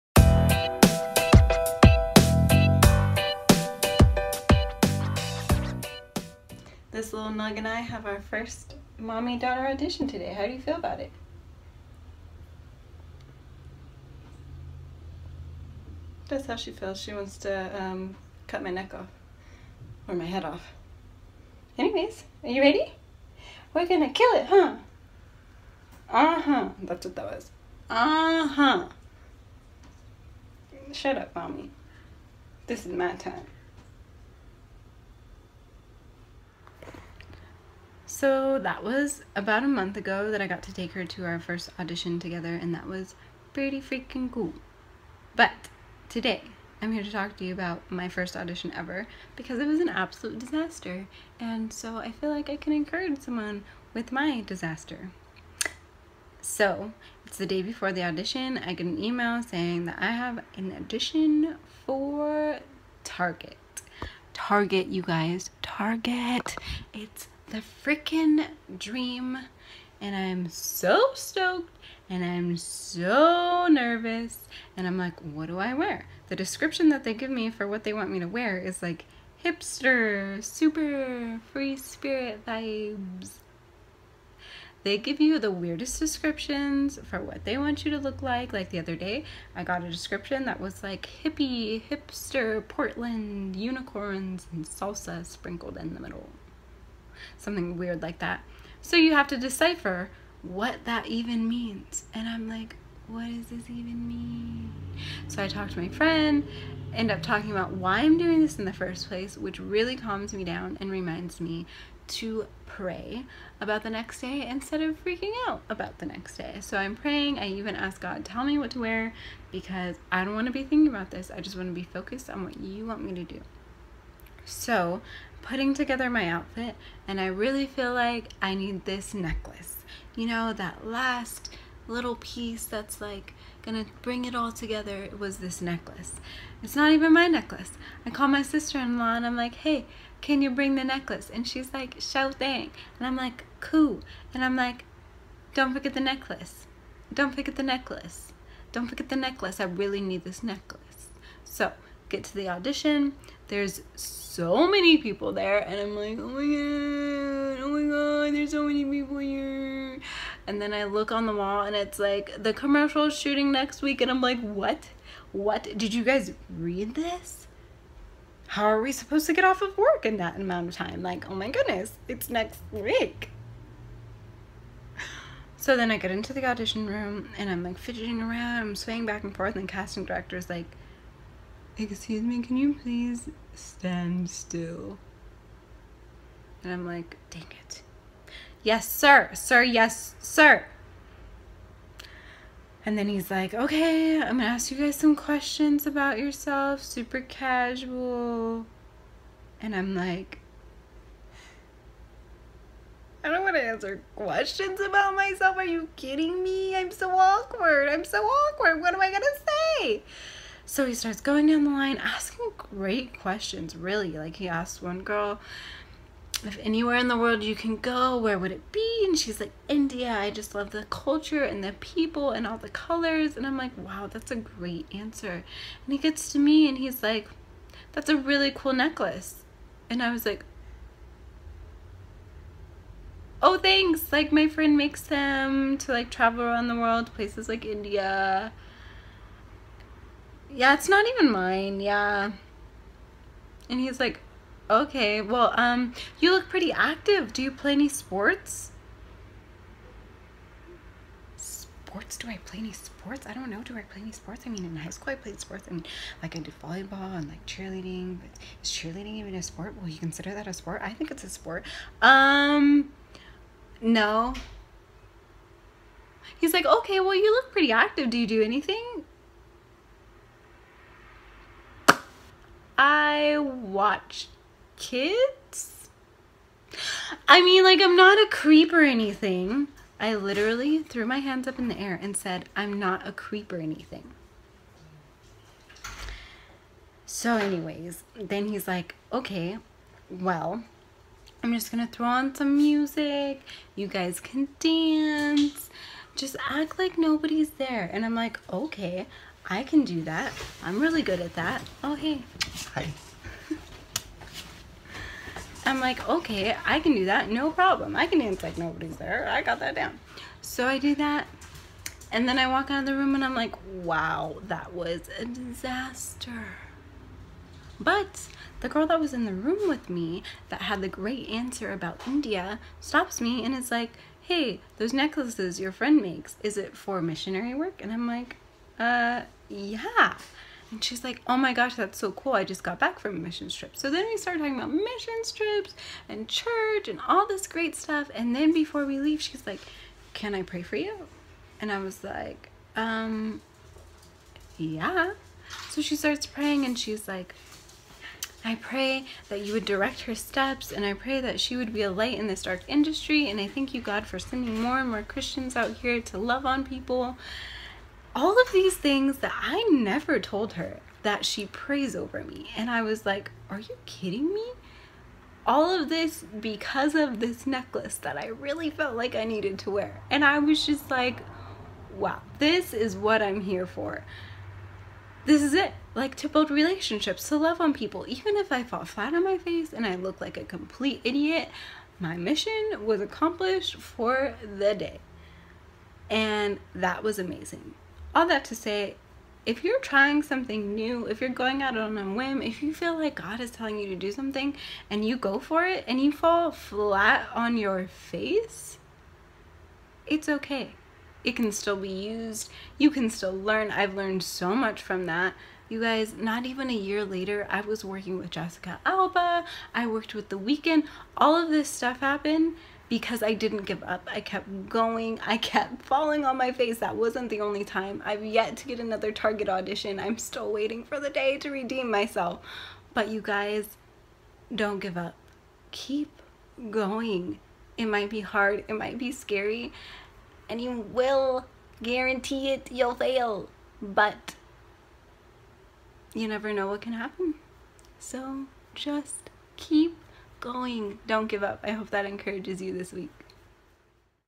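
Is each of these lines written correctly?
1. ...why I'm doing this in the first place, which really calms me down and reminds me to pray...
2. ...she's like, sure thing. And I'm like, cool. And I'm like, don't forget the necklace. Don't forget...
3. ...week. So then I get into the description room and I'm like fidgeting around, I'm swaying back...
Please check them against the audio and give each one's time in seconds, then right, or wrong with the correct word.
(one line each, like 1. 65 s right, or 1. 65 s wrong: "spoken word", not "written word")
1. 107 s right
2. 141 s right
3. 172 s wrong: "audition", not "description".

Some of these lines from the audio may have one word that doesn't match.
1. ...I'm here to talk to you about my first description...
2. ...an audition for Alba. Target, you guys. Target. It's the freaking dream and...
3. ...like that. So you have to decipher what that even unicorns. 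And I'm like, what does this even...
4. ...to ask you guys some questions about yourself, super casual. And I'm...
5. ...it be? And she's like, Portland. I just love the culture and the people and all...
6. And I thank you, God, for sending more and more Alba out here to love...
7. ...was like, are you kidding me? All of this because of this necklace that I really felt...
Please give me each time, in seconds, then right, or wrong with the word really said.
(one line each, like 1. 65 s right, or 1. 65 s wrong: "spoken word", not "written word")
1. 46 s wrong: "audition", not "description"
2. 60 s wrong: "Target", not "Alba"
3. 98 s wrong: "means", not "unicorns"
4. 194 s right
5. 218 s wrong: "India", not "Portland"
6. 353 s wrong: "Christians", not "Alba"
7. 362 s right.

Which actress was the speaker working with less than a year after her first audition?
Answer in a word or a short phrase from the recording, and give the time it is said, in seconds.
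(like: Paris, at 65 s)
Jessica Alba, at 408 s.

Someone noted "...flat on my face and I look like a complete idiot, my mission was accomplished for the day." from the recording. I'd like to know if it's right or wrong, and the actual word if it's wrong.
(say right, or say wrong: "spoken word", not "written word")
right.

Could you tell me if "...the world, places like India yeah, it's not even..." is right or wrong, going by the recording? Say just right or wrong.
right.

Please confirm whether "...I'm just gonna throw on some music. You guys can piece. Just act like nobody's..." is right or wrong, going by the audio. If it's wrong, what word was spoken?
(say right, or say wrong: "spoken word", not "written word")
wrong: "dance", not "piece".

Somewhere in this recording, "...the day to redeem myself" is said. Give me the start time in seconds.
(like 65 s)
420 s.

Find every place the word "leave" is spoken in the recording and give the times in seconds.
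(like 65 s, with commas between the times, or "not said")
338 s.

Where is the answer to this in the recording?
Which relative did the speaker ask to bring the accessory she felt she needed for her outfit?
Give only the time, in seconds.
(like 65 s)
138 s.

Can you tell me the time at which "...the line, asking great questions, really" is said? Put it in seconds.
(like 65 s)
211 s.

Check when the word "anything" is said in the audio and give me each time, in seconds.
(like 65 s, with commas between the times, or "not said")
268 s, 278 s, 283 s.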